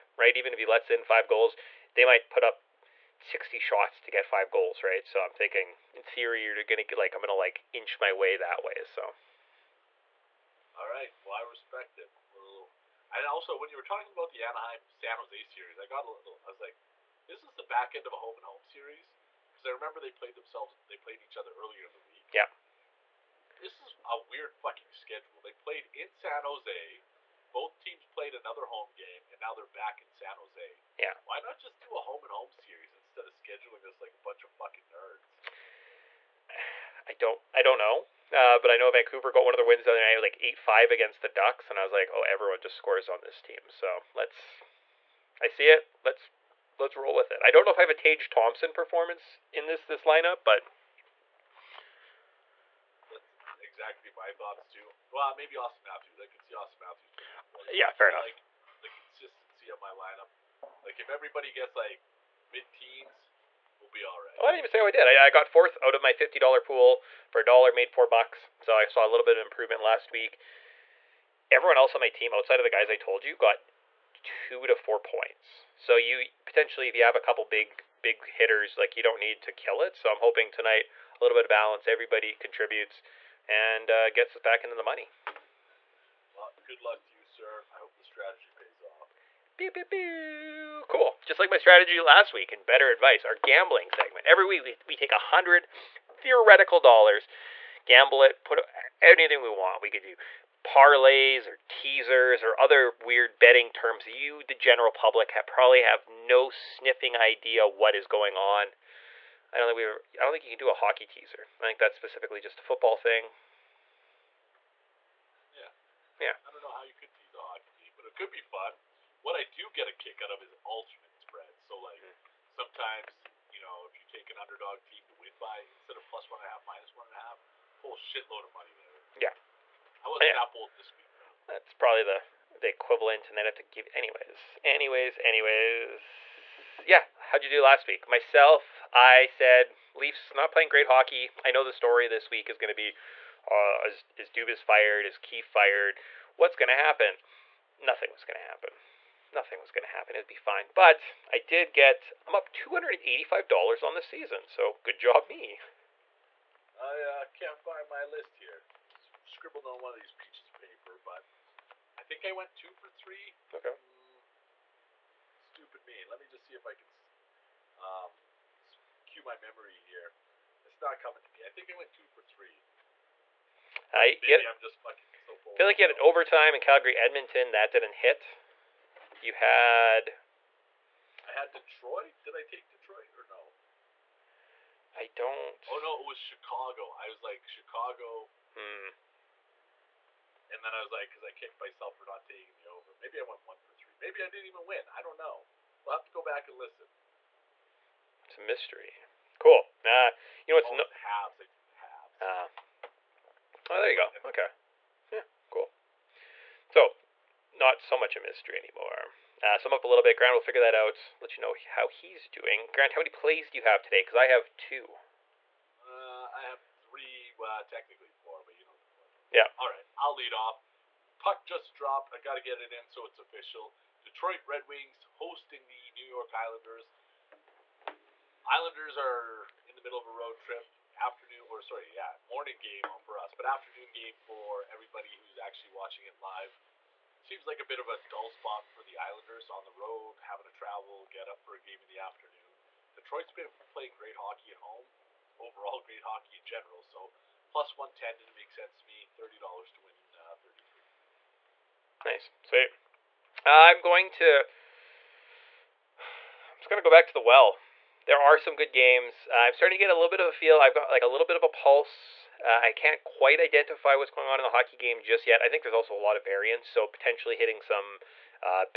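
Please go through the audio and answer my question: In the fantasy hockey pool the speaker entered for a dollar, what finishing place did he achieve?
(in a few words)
fourth.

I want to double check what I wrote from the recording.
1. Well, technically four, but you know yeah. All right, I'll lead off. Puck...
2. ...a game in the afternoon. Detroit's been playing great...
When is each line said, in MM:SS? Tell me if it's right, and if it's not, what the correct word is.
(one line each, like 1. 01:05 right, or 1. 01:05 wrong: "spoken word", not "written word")
1. 03:37 right
2. 04:01 right.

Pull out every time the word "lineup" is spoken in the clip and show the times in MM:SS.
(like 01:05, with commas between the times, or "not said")
00:50, 00:59.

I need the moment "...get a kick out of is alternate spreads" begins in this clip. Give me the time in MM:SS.
01:59.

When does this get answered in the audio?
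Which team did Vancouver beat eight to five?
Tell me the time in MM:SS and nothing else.
00:41.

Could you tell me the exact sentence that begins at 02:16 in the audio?
Yeah, how'd you do last week?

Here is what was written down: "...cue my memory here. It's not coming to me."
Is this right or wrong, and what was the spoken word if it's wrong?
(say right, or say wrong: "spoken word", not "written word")
right.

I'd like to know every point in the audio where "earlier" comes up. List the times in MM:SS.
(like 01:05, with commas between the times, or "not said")
00:21.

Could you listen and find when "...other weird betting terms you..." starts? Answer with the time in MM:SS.
01:42.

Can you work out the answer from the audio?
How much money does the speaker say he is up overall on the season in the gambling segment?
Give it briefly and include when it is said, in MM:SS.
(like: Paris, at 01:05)
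$285, at 02:32.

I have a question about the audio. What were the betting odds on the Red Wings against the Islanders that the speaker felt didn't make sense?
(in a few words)
+110.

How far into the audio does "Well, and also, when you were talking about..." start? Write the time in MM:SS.
00:12.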